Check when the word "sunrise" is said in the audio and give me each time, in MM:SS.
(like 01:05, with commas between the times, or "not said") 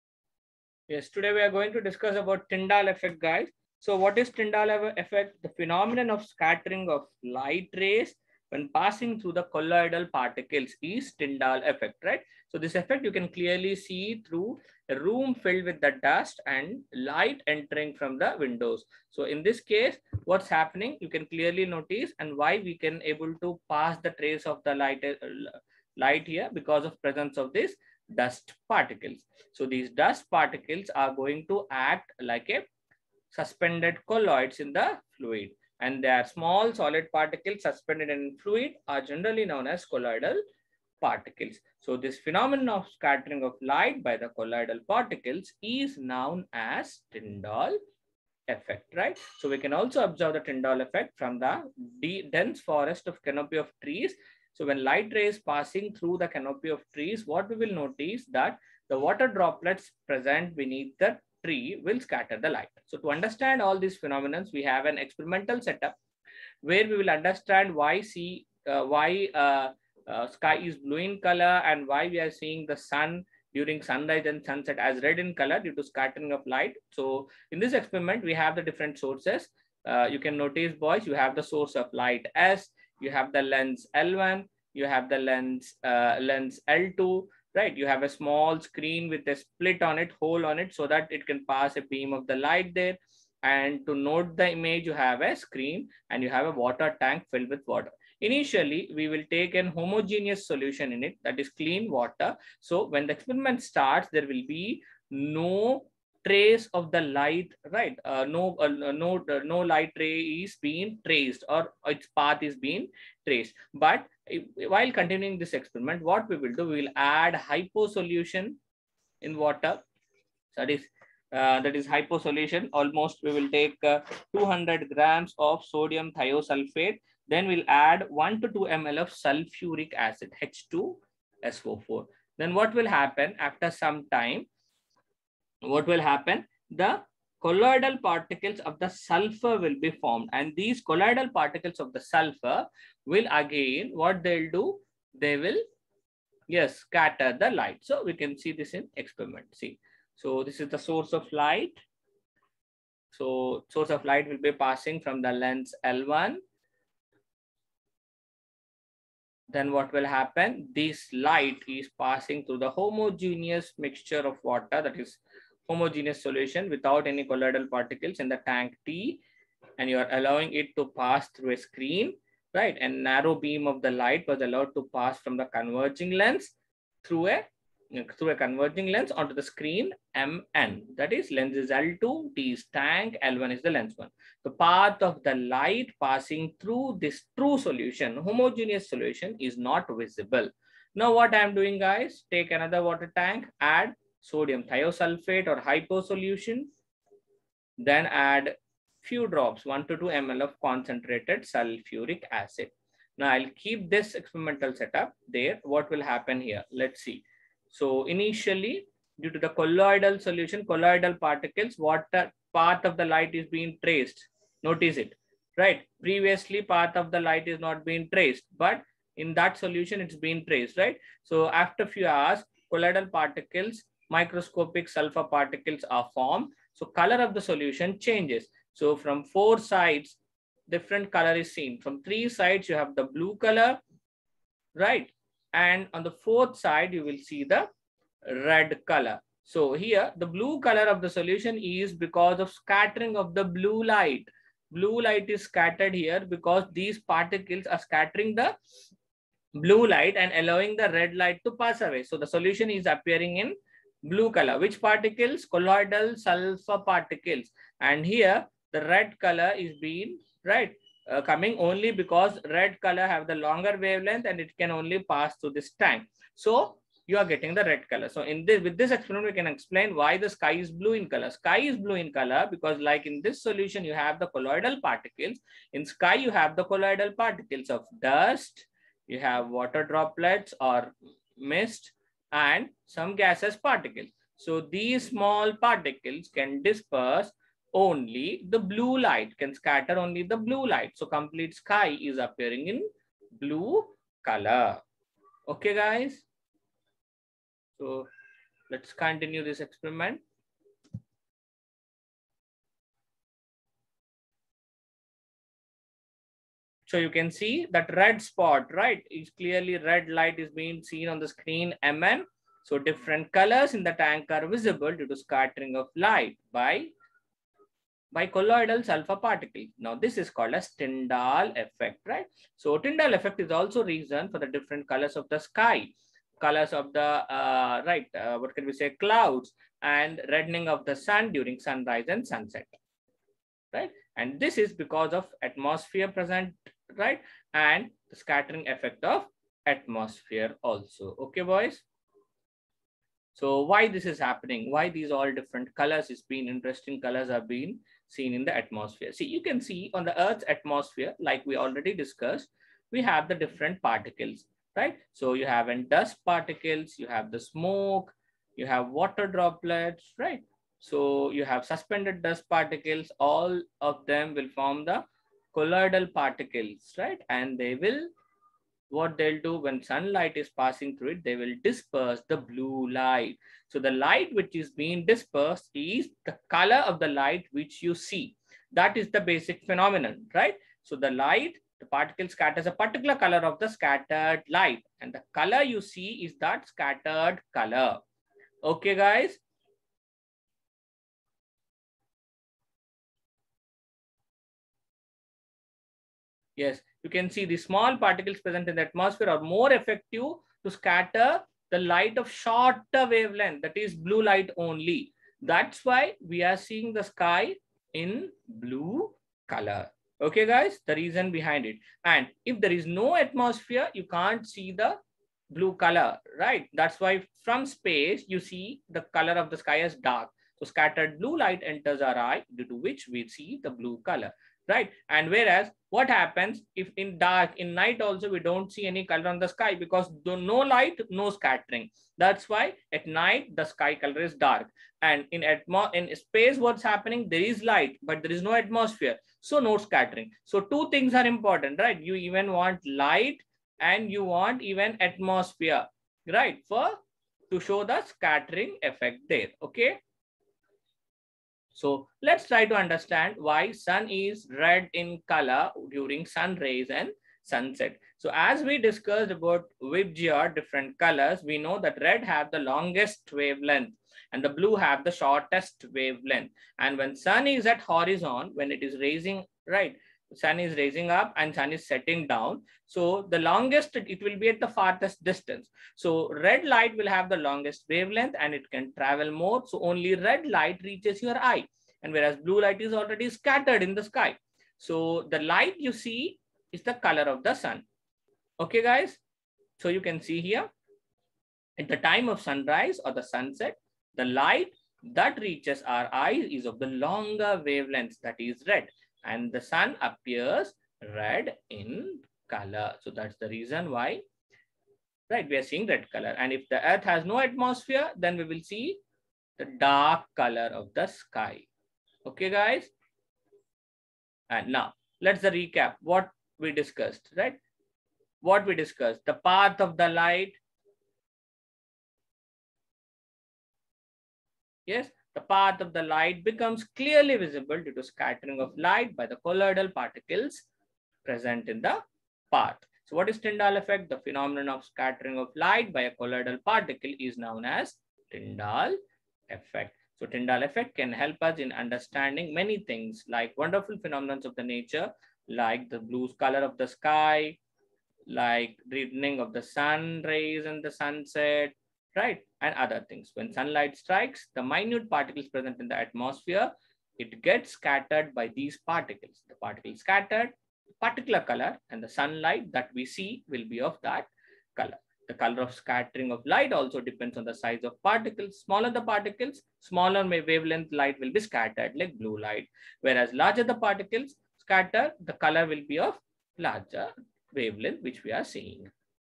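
01:13, 05:31, 08:12.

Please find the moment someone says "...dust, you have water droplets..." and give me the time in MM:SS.
04:38.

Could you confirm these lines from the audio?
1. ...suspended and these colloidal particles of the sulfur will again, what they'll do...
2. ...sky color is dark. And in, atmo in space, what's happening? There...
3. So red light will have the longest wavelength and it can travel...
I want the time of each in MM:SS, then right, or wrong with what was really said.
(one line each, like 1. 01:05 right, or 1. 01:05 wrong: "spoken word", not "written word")
1. 02:19 wrong: "formed", not "suspended"
2. 07:13 right
3. 07:55 right.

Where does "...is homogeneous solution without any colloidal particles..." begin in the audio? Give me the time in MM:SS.
02:44.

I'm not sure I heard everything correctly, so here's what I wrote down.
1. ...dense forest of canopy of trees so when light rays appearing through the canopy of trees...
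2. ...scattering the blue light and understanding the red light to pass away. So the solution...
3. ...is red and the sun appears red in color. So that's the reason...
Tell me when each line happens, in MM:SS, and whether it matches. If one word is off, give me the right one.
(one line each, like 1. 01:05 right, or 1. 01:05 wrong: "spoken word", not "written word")
1. 00:52 wrong: "passing", not "appearing"
2. 04:07 wrong: "allowing", not "understanding"
3. 08:18 right.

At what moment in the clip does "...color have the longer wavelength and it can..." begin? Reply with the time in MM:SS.
04:22.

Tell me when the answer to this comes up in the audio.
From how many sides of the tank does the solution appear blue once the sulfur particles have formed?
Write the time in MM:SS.
03:52.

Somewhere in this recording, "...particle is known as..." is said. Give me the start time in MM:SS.
08:56.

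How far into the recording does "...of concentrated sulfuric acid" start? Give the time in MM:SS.
03:20.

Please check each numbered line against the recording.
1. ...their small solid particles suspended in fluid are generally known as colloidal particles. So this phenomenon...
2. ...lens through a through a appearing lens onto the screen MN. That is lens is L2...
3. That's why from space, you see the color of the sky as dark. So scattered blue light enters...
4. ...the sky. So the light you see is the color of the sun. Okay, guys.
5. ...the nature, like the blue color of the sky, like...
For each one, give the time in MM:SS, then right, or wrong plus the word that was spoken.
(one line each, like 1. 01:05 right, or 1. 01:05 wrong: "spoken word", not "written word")
1. 00:36 right
2. 02:56 wrong: "converging", not "appearing"
3. 06:56 right
4. 08:03 right
5. 09:04 right.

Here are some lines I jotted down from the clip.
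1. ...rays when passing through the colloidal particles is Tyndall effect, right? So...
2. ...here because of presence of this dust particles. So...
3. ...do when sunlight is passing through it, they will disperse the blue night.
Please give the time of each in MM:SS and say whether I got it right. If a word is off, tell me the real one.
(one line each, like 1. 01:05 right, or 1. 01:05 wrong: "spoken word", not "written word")
1. 00:07 right
2. 00:26 right
3. 06:09 wrong: "light", not "night".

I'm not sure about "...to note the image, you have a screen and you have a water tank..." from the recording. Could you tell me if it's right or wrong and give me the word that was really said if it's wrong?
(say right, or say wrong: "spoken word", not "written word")
right.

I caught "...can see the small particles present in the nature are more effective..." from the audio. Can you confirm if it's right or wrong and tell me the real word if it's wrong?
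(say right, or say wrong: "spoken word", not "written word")
wrong: "atmosphere", not "nature".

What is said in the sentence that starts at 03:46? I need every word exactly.
So color of the solution changes.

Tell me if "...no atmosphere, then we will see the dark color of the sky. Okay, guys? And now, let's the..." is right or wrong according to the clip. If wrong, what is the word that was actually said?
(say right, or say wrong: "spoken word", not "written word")
right.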